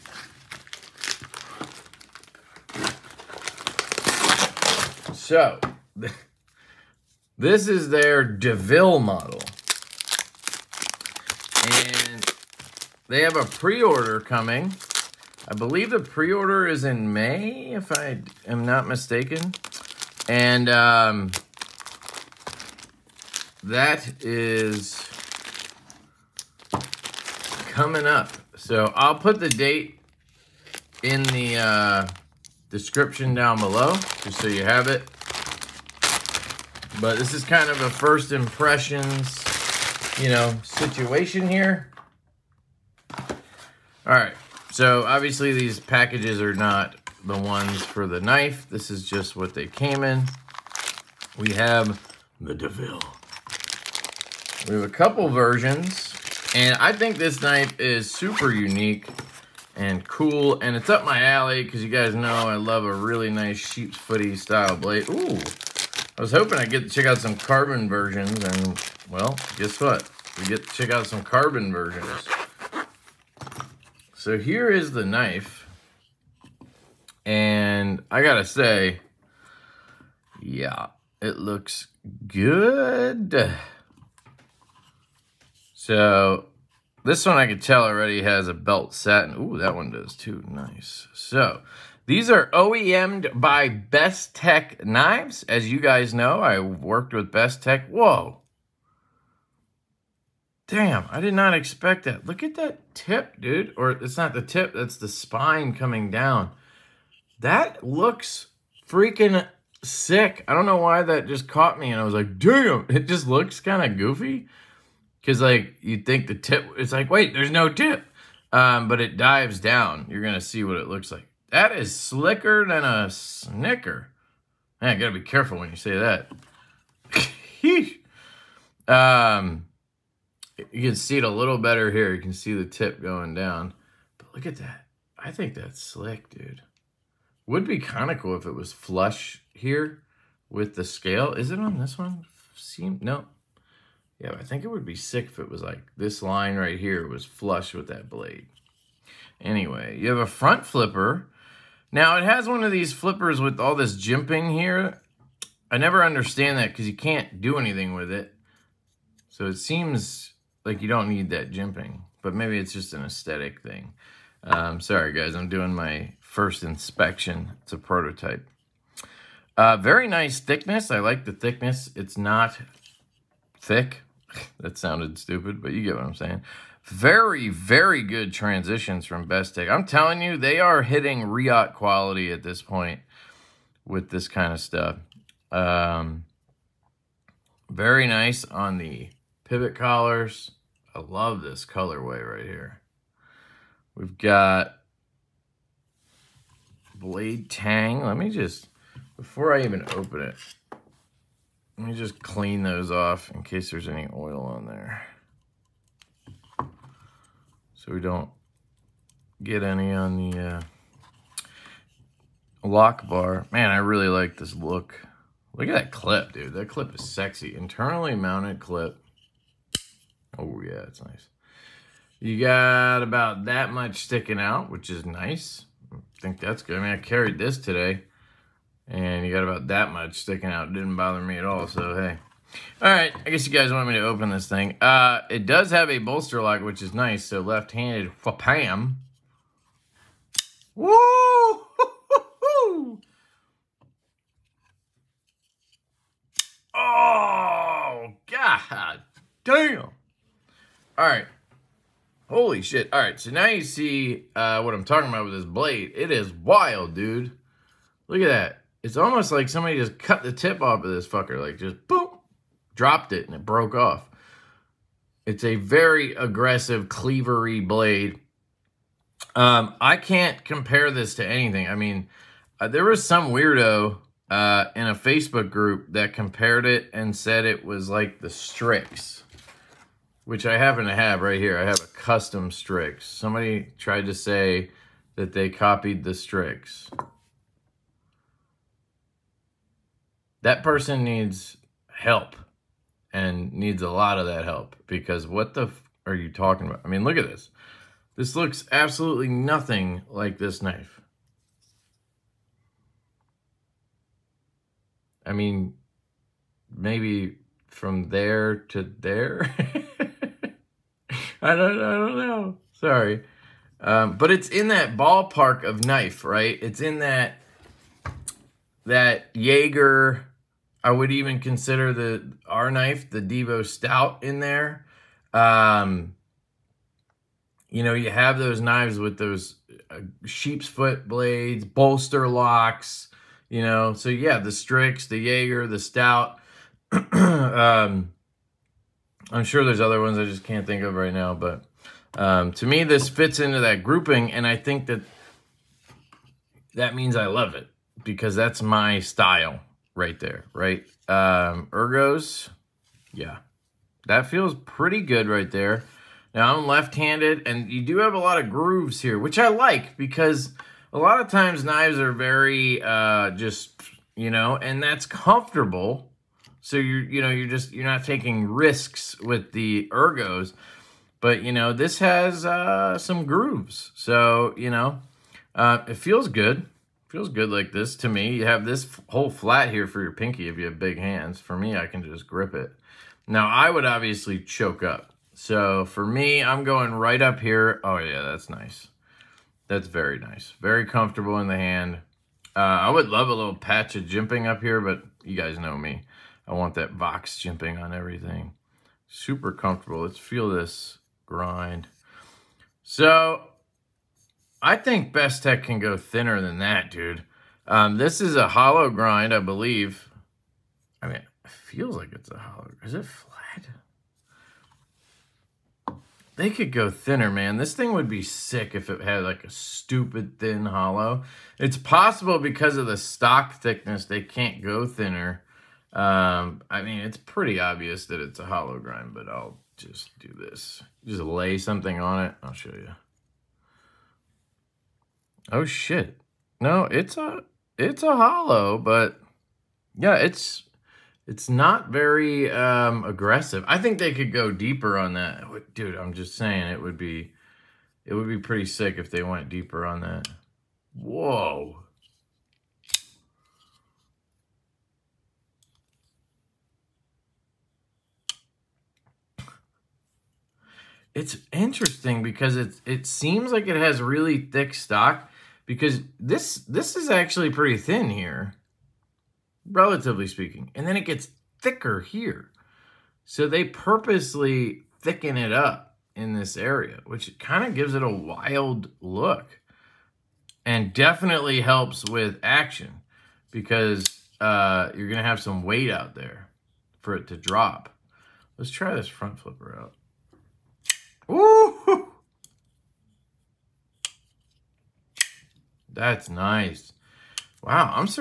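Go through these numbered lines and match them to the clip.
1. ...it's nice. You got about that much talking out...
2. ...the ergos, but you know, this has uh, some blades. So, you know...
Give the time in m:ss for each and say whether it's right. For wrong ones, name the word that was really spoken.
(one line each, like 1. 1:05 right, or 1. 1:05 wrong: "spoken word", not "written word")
1. 3:40 wrong: "sticking", not "talking"
2. 6:09 wrong: "grooves", not "blades".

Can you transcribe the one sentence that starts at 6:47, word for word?
Um, this is a hollow grind, I believe.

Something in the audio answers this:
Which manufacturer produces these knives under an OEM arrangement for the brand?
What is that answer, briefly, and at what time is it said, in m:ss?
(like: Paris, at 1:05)
Best Tech Knives, at 1:33.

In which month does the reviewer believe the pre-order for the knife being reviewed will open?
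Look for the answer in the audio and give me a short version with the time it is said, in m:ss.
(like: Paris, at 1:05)
May, at 0:17.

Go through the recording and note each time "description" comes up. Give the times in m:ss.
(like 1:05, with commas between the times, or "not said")
0:32.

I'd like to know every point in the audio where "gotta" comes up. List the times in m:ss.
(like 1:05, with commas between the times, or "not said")
1:18, 2:04.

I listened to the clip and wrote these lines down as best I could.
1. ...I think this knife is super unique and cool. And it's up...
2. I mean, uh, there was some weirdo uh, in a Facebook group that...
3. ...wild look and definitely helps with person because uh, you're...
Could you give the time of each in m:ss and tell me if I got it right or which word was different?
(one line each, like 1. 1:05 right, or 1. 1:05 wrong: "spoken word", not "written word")
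1. 0:56 right
2. 4:31 right
3. 7:58 wrong: "action", not "person".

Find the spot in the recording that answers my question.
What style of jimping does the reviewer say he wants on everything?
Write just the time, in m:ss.
6:36.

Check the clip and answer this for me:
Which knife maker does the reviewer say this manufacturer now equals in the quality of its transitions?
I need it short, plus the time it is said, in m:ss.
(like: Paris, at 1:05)
Riot, at 3:01.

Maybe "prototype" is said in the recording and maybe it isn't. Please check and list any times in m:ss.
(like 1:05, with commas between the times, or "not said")
2:47.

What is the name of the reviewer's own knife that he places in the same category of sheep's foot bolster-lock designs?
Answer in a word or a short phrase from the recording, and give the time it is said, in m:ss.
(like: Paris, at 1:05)
Devo Stout, at 5:23.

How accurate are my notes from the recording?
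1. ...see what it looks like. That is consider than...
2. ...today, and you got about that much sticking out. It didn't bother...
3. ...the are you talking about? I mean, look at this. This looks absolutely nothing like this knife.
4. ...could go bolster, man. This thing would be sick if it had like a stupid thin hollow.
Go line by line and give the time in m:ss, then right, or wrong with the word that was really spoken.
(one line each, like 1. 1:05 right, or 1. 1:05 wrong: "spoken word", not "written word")
1. 2:00 wrong: "slicker", not "consider"
2. 3:47 right
3. 4:55 right
4. 6:56 wrong: "thinner", not "bolster".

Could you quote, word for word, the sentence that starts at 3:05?
Um, very nice on the pivot collars.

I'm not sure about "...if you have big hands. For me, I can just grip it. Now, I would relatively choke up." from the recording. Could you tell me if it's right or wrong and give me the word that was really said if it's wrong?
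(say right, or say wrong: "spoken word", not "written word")
wrong: "obviously", not "relatively".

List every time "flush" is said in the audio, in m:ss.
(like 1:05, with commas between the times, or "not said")
2:18, 2:27.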